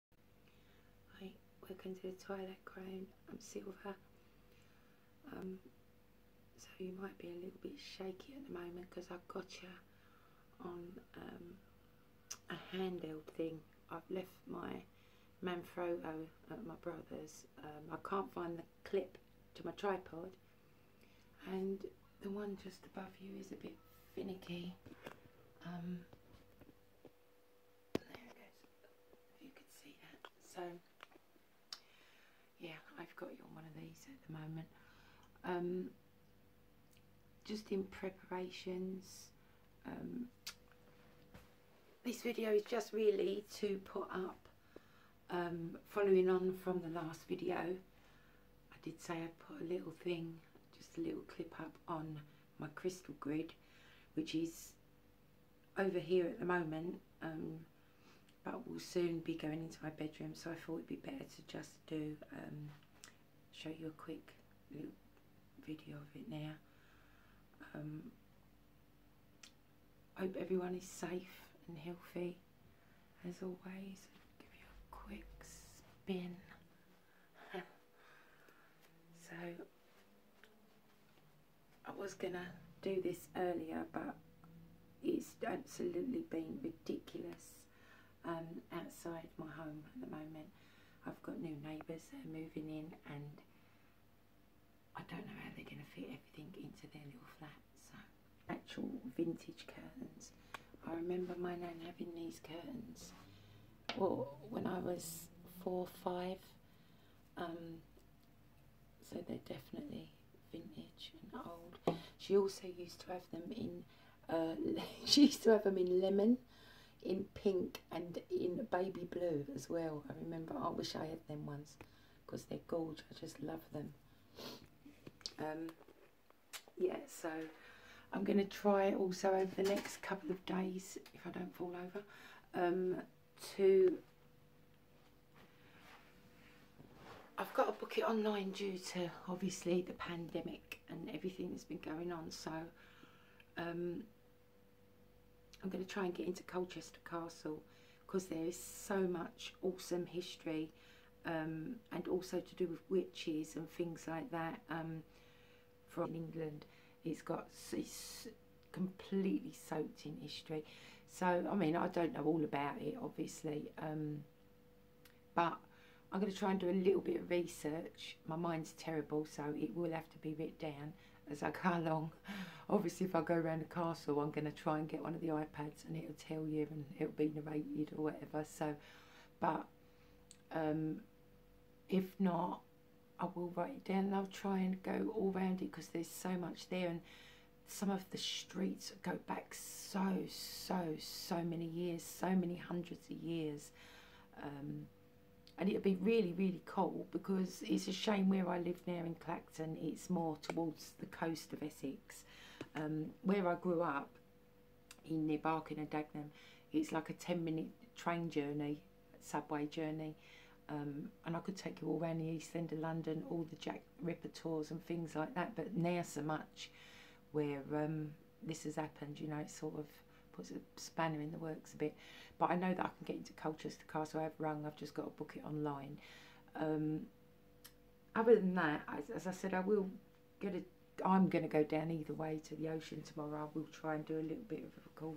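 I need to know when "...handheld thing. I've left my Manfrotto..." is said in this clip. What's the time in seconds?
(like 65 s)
12 s.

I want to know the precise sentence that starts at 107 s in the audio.
Um, so they're definitely vintage and old.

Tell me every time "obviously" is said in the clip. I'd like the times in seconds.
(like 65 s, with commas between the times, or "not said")
139 s, 163 s, 172 s.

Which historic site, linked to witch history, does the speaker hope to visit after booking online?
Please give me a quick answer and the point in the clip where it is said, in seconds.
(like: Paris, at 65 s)
Colchester Castle, at 146 s.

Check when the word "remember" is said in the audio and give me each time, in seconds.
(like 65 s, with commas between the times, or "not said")
100 s, 120 s.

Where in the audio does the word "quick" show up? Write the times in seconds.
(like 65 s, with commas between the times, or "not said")
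64 s, 74 s.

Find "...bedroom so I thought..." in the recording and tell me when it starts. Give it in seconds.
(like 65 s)
59 s.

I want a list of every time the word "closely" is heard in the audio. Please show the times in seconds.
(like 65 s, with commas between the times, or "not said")
not said.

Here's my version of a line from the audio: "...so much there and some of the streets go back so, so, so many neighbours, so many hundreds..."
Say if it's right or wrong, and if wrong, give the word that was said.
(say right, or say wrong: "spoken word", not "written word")
wrong: "years", not "neighbours".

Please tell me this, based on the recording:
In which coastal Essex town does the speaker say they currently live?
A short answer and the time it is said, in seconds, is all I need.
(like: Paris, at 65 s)
Clacton, at 199 s.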